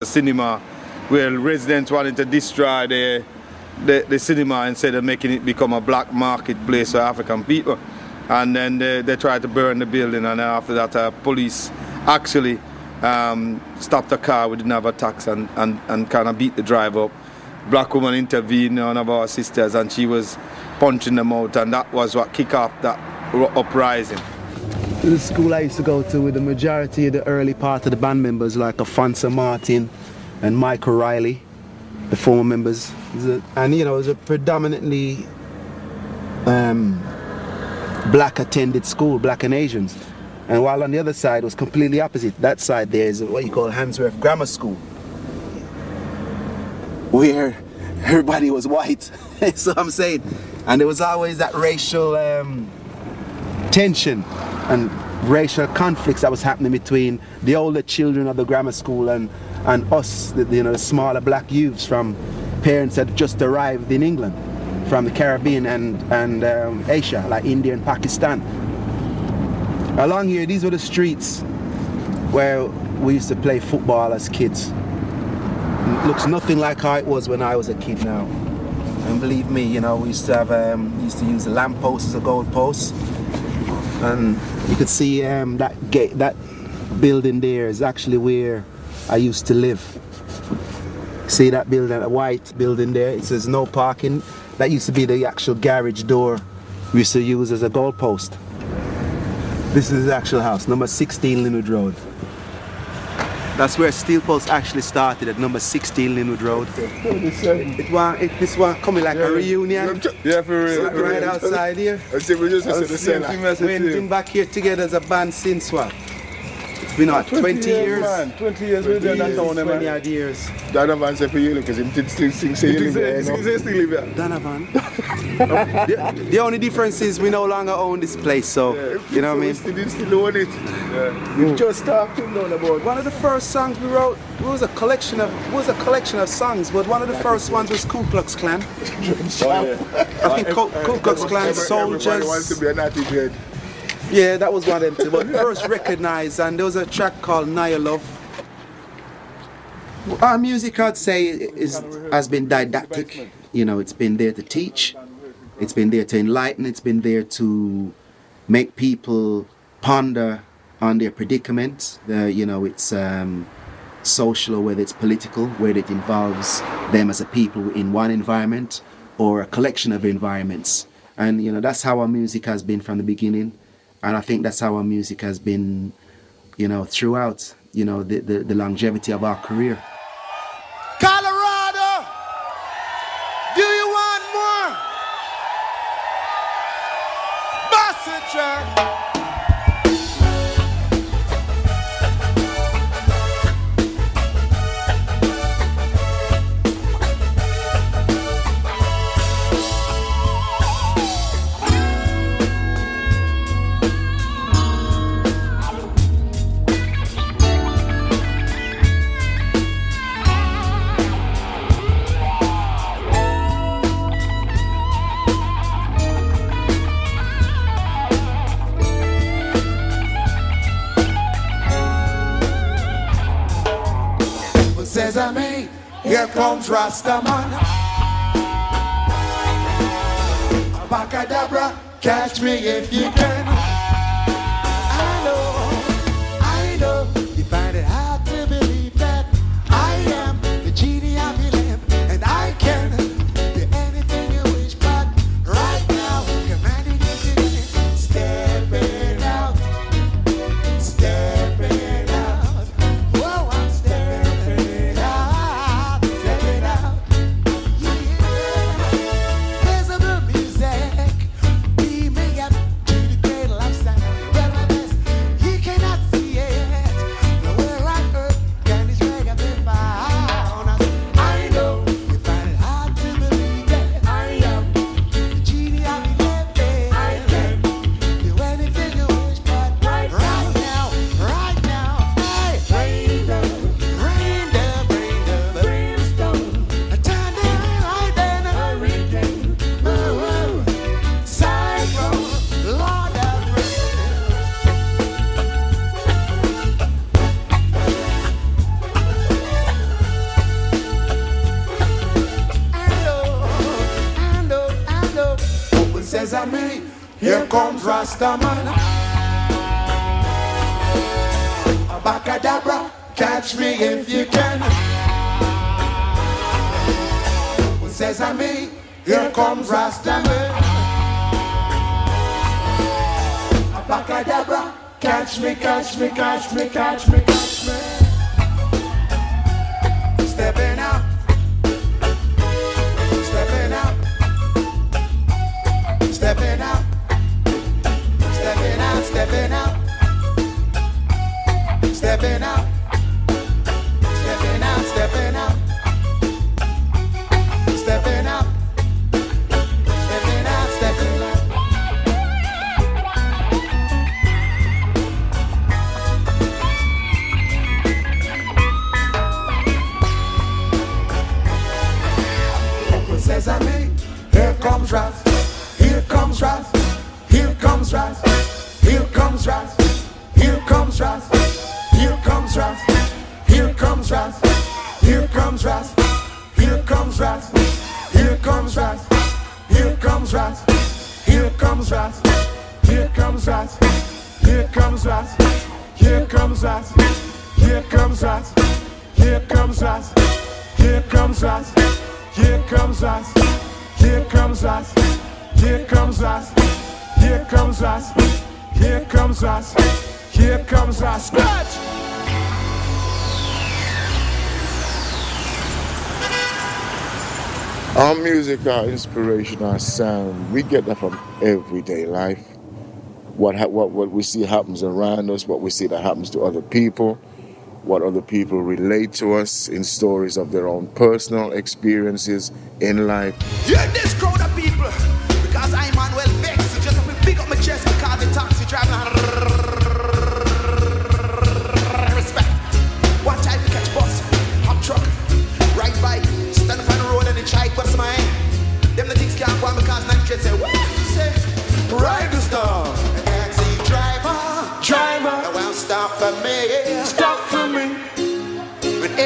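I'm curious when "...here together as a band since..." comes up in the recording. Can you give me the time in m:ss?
1:54.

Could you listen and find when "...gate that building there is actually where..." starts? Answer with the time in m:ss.
1:25.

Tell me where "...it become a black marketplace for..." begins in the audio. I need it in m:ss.
0:05.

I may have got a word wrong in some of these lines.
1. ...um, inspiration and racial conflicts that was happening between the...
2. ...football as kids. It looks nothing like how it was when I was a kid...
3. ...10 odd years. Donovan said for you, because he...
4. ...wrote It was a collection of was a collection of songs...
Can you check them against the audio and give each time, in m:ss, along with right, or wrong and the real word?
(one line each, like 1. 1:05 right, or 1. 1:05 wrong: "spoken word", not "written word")
1. 0:52 wrong: "tension", not "inspiration"
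2. 1:13 right
3. 1:59 wrong: "20", not "10"
4. 2:13 right.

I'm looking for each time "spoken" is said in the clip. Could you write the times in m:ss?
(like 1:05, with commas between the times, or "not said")
not said.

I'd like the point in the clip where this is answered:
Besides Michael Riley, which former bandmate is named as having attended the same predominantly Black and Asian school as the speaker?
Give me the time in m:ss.
0:28.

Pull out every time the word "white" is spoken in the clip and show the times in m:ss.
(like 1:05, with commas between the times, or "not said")
0:48, 1:32.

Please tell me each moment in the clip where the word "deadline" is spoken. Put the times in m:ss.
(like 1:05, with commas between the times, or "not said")
not said.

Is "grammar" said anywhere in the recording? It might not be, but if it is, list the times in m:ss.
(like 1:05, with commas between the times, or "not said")
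0:44, 0:58.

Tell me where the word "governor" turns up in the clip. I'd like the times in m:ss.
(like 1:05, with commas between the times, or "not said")
not said.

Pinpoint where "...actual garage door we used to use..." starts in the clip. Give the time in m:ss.
1:35.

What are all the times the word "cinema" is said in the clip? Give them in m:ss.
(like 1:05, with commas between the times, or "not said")
0:00, 0:04.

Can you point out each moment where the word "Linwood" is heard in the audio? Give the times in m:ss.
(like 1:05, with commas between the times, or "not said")
1:41, 1:46.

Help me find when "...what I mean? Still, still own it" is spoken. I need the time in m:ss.
2:09.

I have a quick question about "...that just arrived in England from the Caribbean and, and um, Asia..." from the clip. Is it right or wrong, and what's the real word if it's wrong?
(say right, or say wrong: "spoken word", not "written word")
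right.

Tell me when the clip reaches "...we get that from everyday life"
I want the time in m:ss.
6:50.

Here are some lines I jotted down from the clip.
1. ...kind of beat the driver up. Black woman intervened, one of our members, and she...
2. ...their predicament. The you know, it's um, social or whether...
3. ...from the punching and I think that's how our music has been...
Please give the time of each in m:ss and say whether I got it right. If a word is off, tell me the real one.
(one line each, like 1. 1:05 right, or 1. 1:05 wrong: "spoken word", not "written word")
1. 0:16 wrong: "sisters", not "members"
2. 2:40 right
3. 2:52 wrong: "beginning", not "punching".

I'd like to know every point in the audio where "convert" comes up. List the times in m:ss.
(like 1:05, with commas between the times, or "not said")
not said.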